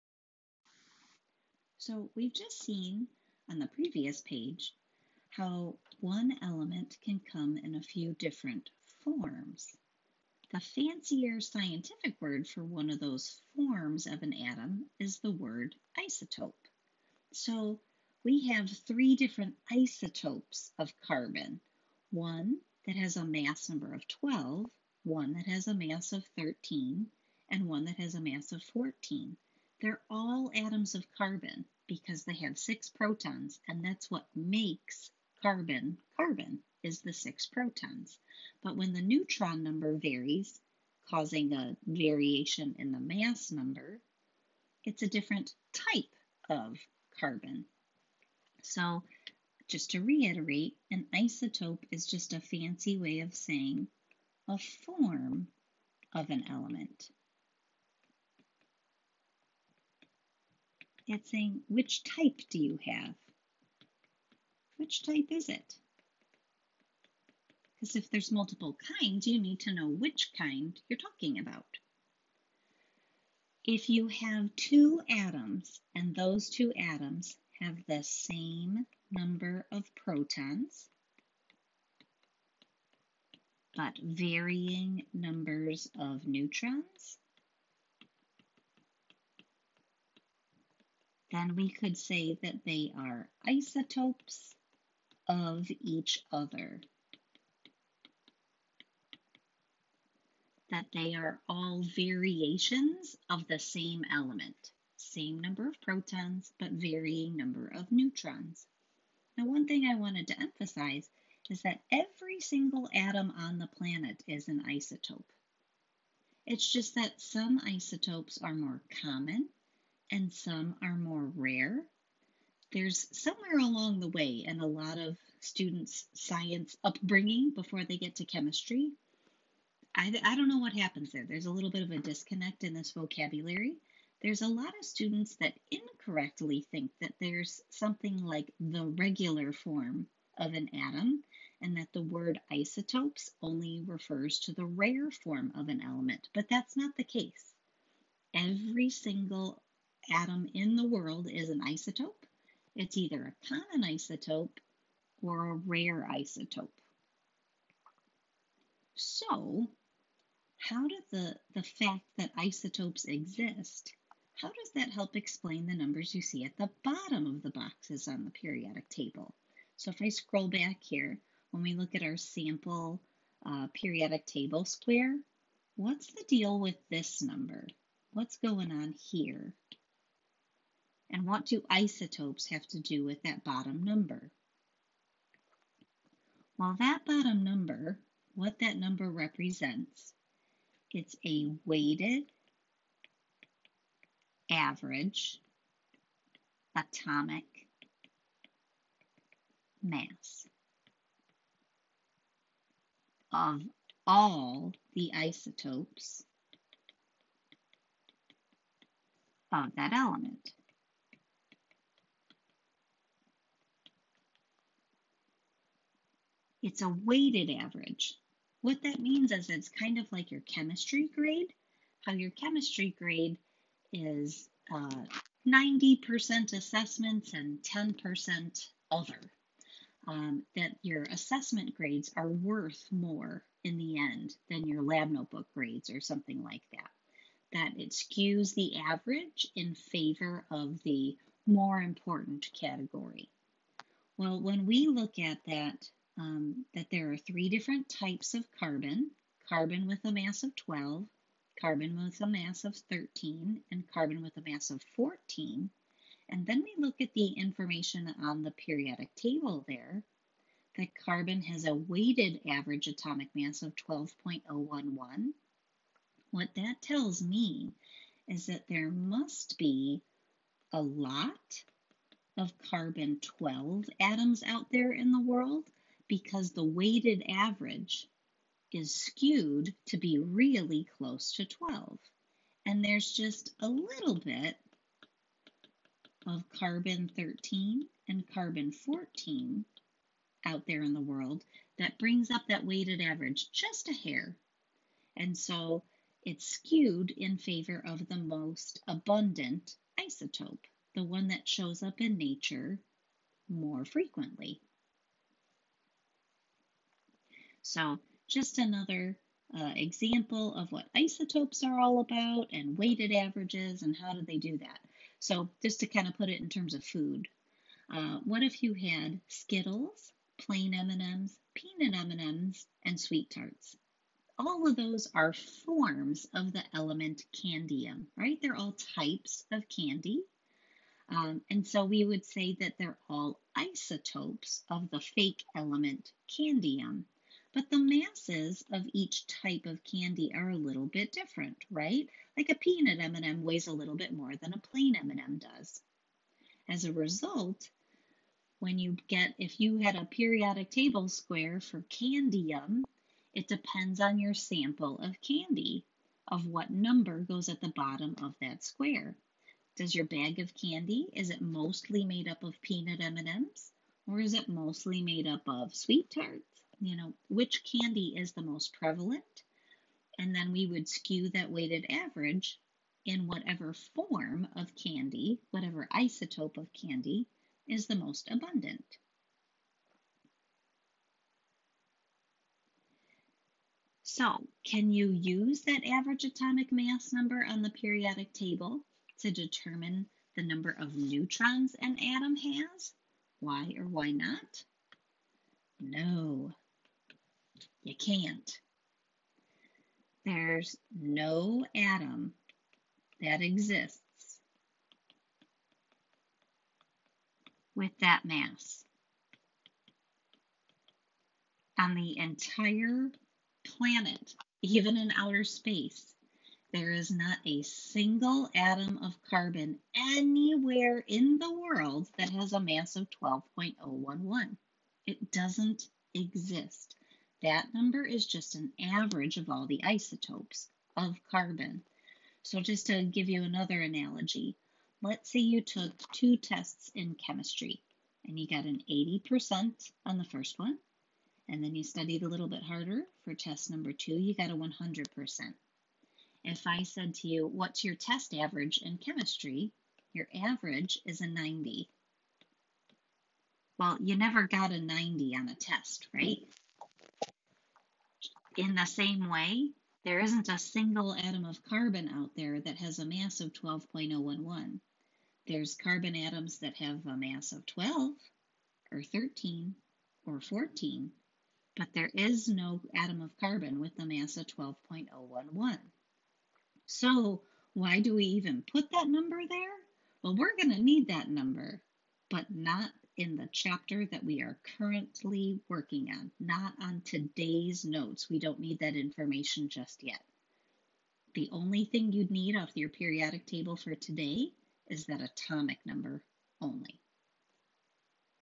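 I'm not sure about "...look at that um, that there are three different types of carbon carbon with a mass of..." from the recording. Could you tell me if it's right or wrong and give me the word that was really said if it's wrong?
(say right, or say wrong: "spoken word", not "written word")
right.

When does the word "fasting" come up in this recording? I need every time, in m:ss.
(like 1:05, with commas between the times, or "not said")
not said.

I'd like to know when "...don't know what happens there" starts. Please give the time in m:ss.
2:10.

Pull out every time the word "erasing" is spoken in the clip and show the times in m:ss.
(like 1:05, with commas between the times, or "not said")
not said.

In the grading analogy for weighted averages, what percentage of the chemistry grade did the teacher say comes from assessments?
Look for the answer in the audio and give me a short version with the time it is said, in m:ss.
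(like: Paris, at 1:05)
90%, at 3:44.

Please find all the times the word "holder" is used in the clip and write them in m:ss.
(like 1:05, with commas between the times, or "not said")
not said.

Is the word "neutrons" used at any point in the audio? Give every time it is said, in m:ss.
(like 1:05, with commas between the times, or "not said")
0:39, 1:26, 1:47, 6:30.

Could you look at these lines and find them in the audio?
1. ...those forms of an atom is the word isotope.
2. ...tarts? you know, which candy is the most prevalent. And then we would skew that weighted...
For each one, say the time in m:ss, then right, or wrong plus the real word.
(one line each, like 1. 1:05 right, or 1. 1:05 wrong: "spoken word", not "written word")
1. 0:12 right
2. 6:06 right.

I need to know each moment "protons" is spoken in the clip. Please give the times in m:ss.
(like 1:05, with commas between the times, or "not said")
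0:32, 0:37, 1:19, 1:45.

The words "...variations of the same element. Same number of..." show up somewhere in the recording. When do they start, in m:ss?
1:41.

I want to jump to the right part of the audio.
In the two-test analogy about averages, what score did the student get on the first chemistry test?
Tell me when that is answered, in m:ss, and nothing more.
7:18.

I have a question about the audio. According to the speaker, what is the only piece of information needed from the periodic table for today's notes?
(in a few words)
atomic number.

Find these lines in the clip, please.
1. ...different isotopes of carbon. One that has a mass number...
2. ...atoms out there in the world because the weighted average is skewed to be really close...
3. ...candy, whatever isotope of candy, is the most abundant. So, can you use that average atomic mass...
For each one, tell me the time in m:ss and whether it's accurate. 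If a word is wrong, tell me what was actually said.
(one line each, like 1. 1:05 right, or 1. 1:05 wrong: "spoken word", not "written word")
1. 0:19 right
2. 4:33 right
3. 6:14 right.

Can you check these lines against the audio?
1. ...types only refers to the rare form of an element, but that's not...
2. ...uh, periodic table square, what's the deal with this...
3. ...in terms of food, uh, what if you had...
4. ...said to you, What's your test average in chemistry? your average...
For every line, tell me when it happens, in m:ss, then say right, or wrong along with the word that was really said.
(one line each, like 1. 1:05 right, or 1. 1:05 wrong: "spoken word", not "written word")
1. 2:22 wrong: "isotopes", not "types"
2. 2:53 right
3. 5:16 right
4. 7:26 right.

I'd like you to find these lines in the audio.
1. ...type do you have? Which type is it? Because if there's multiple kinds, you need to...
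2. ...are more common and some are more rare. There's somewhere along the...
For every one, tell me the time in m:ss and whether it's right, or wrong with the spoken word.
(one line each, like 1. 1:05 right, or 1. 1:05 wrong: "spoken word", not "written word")
1. 1:02 right
2. 1:58 right.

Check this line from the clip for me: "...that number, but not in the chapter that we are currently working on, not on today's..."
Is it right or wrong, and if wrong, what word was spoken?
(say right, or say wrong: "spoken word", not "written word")
right.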